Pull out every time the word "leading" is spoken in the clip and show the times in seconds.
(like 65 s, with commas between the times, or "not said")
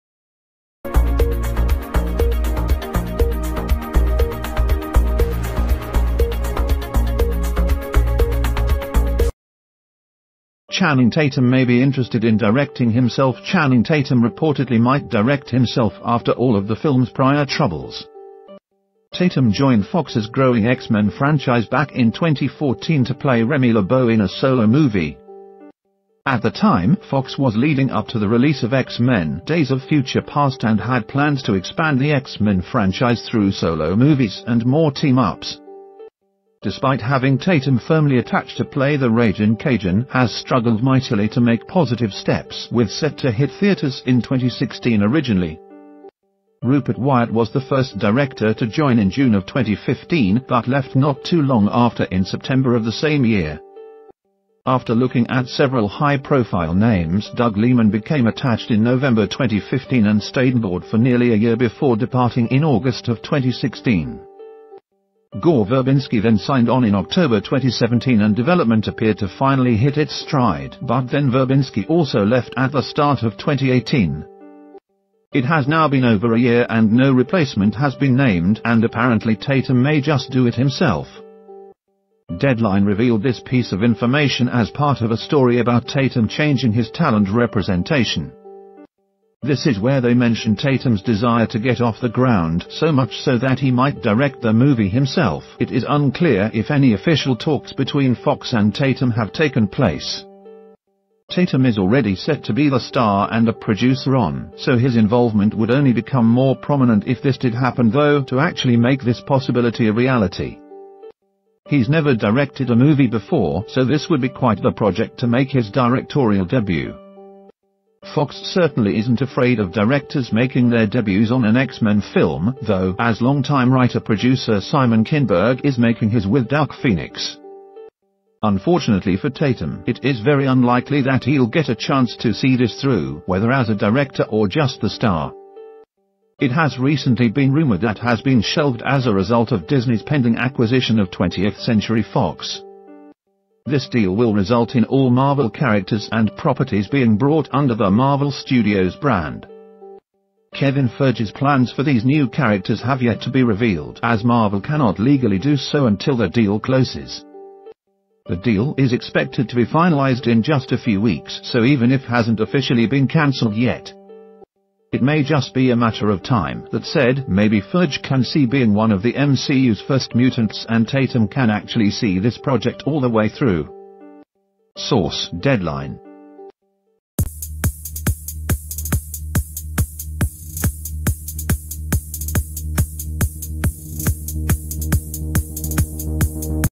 27 s.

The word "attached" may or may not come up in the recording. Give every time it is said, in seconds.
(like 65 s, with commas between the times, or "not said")
38 s, 58 s.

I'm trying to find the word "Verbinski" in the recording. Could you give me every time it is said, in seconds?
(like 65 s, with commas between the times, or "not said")
65 s, 71 s.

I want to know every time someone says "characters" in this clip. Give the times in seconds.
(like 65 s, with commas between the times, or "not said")
145 s, 152 s.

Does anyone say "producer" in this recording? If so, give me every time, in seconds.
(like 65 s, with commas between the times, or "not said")
103 s, 123 s.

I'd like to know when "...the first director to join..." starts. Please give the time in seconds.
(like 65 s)
47 s.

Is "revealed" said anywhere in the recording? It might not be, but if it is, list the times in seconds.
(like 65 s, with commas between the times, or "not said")
82 s, 153 s.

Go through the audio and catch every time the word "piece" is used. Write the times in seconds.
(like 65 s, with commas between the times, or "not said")
83 s.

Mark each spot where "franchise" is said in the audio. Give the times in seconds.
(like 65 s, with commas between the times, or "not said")
21 s, 32 s.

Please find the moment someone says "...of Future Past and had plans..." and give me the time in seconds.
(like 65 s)
29 s.